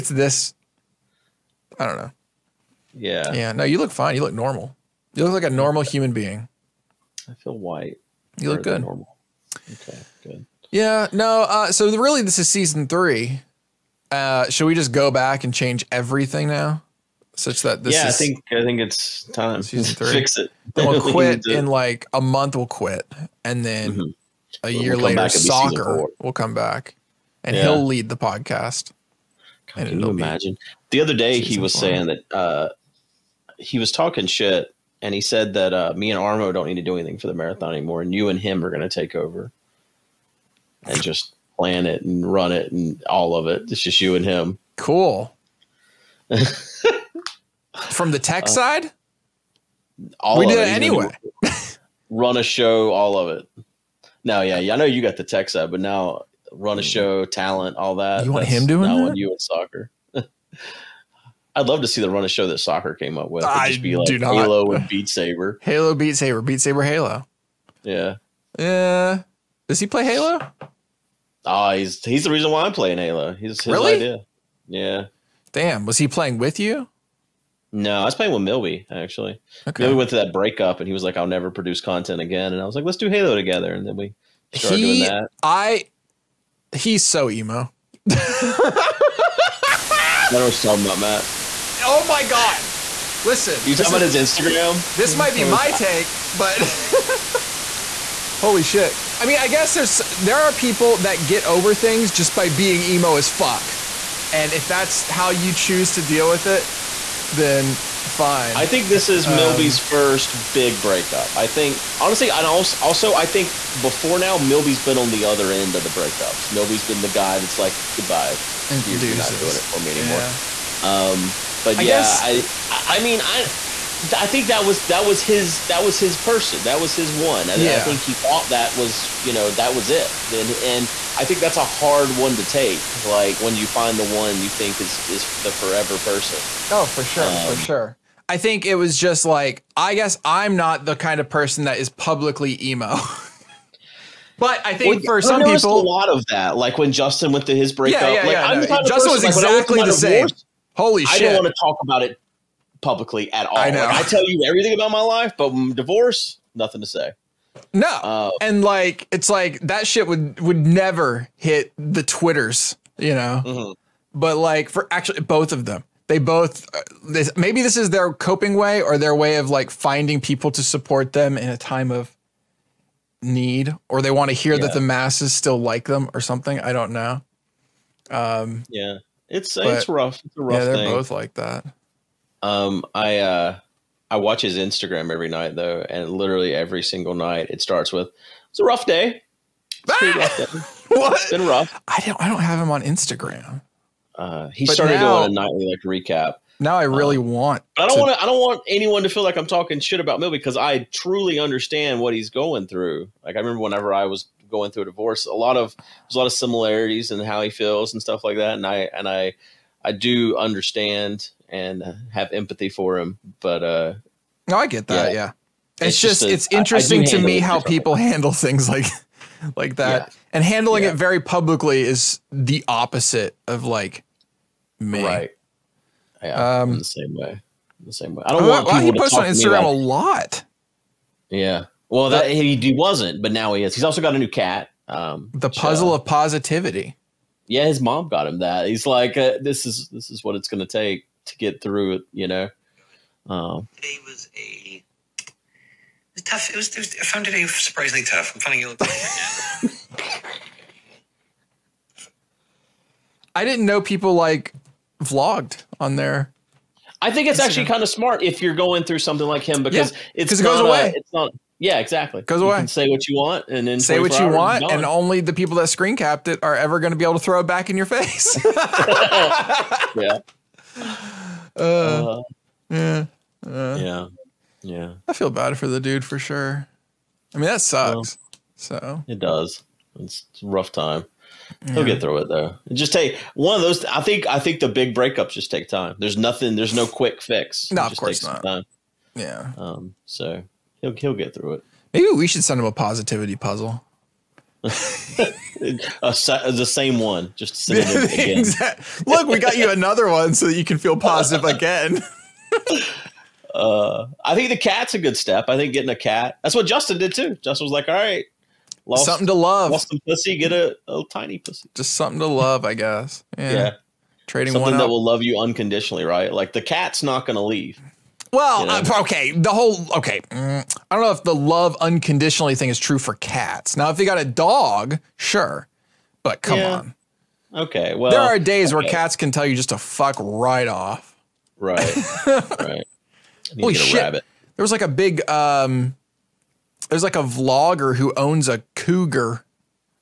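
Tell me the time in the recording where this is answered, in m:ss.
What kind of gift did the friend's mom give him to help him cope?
3:55.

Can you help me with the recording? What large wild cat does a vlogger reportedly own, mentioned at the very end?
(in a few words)
Cougar.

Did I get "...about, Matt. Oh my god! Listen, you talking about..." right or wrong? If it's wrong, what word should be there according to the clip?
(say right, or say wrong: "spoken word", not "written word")
right.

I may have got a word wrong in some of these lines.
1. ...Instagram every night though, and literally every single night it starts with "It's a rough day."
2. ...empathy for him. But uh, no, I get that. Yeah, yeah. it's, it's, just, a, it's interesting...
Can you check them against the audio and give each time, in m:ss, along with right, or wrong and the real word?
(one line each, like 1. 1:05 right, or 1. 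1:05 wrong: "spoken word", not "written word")
1. 3:04 right
2. 3:32 right.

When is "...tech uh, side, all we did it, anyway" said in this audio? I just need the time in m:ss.
0:48.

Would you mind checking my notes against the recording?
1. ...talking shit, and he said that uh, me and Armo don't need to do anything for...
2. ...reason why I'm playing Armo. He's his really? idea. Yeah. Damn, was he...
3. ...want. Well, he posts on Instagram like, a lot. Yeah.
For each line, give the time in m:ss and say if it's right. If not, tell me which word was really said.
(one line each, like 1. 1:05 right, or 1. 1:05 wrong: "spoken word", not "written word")
1. 0:33 right
2. 1:12 wrong: "Halo", not "Armo"
3. 3:48 right.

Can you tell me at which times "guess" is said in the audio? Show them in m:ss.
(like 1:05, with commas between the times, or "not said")
1:39, 2:01, 2:19, 5:12.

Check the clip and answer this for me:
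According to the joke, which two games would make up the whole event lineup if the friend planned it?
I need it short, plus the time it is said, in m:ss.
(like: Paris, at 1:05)
Halo and Beat Saber, at 1:04.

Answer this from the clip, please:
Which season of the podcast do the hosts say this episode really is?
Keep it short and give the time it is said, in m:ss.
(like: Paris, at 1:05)
Season 3, at 0:12.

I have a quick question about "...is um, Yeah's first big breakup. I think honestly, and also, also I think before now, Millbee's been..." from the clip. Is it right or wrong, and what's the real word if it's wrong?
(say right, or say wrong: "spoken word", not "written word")
wrong: "Millbee", not "Yeah".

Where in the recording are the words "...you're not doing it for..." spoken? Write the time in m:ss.
1:58.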